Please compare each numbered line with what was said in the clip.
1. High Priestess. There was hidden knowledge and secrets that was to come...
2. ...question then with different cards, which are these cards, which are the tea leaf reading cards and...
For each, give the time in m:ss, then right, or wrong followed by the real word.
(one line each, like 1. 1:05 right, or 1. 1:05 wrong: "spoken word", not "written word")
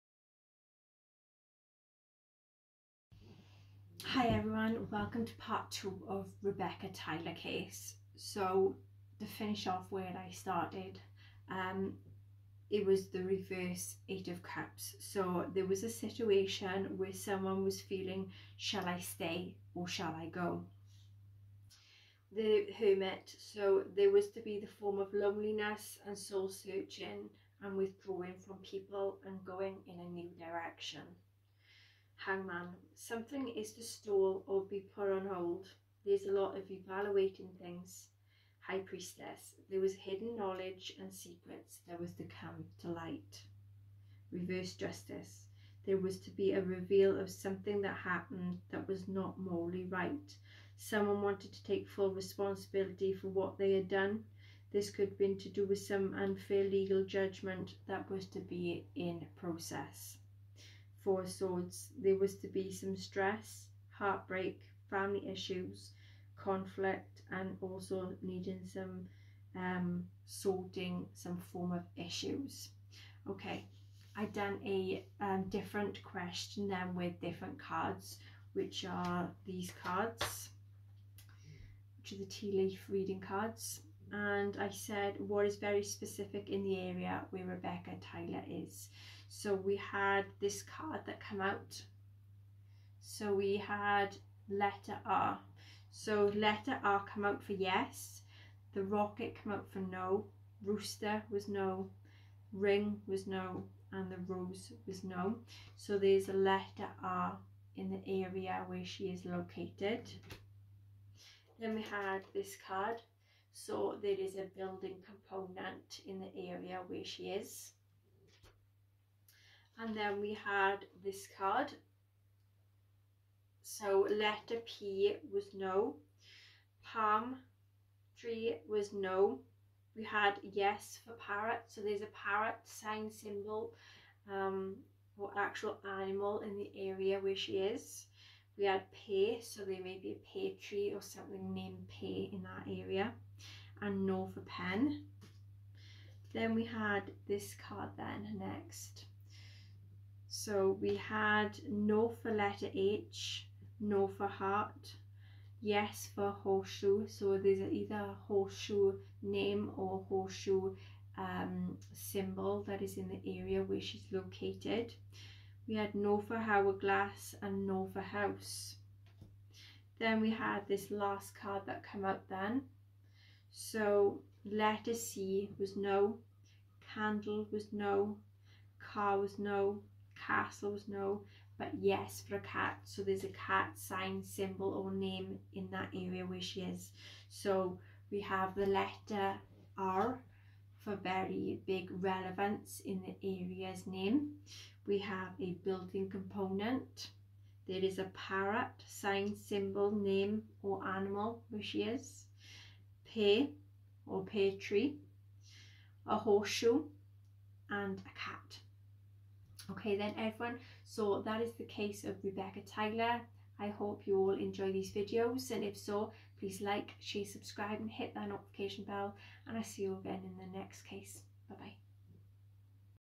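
1. 0:38 right
2. 1:16 right.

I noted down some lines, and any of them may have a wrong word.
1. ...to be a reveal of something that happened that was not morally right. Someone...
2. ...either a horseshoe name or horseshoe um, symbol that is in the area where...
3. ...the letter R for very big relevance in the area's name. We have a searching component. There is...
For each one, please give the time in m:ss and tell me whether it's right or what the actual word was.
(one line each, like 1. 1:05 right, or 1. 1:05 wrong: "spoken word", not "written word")
1. 0:46 right
2. 2:37 right
3. 3:08 wrong: "building", not "searching".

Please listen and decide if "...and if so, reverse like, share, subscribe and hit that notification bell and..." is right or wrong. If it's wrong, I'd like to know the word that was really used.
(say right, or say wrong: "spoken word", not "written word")
wrong: "please", not "reverse".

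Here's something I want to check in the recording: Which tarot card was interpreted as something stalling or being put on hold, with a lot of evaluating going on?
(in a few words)
Hangman.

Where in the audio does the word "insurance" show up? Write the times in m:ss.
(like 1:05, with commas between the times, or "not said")
not said.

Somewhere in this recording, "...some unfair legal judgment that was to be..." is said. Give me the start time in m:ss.
0:55.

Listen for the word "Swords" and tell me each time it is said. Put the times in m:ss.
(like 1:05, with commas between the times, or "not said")
1:01.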